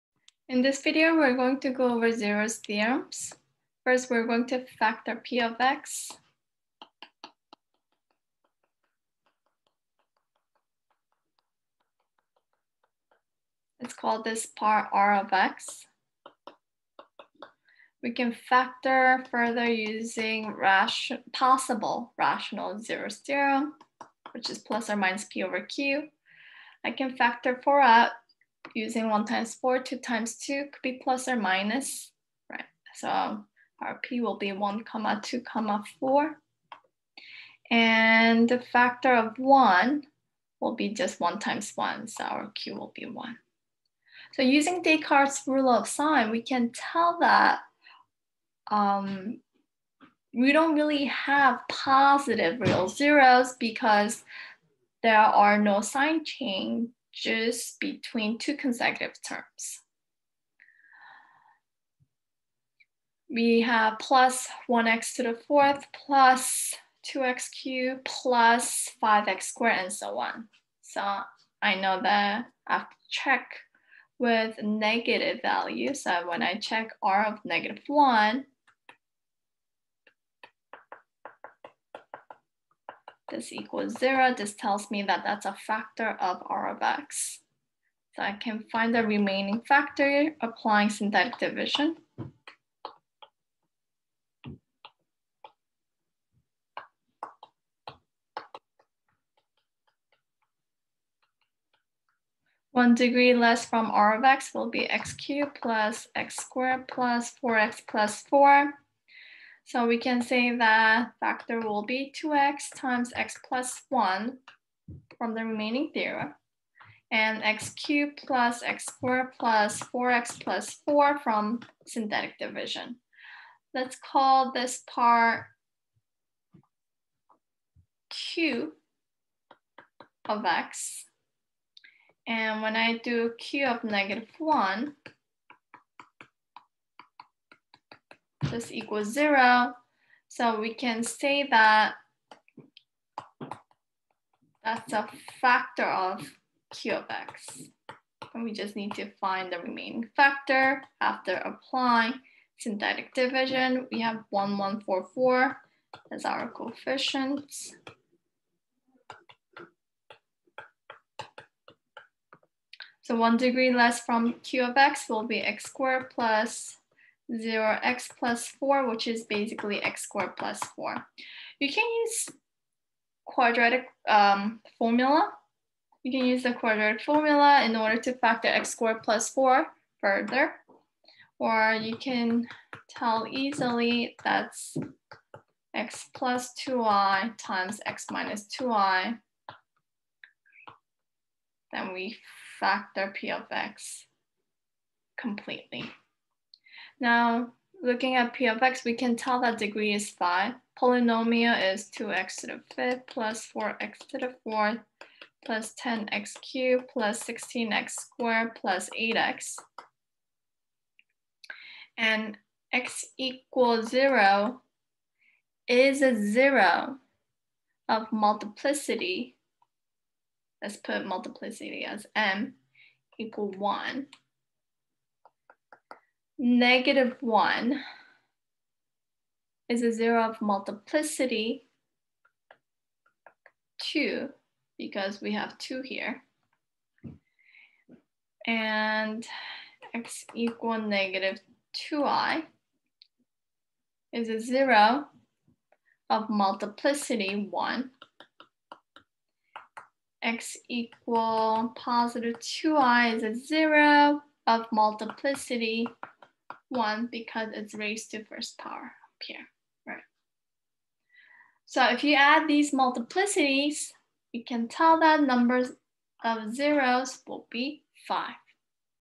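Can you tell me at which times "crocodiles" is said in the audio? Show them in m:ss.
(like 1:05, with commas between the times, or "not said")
not said.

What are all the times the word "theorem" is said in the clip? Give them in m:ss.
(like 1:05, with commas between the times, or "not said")
0:02, 0:23, 1:55.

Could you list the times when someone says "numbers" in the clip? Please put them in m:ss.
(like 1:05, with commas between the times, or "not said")
4:25.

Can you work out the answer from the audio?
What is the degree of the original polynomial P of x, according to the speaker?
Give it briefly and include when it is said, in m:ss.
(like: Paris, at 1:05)
5, at 3:19.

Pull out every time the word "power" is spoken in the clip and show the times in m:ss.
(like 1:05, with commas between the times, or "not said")
4:18.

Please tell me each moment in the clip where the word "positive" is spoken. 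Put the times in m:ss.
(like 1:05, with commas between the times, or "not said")
0:51, 4:11.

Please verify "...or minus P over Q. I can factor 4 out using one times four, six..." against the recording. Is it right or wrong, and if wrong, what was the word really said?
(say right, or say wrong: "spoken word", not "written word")
wrong: "two", not "six".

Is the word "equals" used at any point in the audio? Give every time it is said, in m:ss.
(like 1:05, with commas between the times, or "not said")
1:23, 2:18, 3:33, 3:43, 4:00, 4:10.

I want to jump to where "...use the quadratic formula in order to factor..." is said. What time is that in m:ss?
2:56.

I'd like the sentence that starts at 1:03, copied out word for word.
We have plus 1x to the fourth, plus 2x cubed, plus 5x squared, and so on.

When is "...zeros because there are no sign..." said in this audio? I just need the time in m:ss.
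0:52.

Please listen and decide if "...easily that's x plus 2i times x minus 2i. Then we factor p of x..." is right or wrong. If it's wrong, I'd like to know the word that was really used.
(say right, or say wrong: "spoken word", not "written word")
right.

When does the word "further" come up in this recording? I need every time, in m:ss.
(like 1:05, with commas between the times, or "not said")
0:19, 3:00.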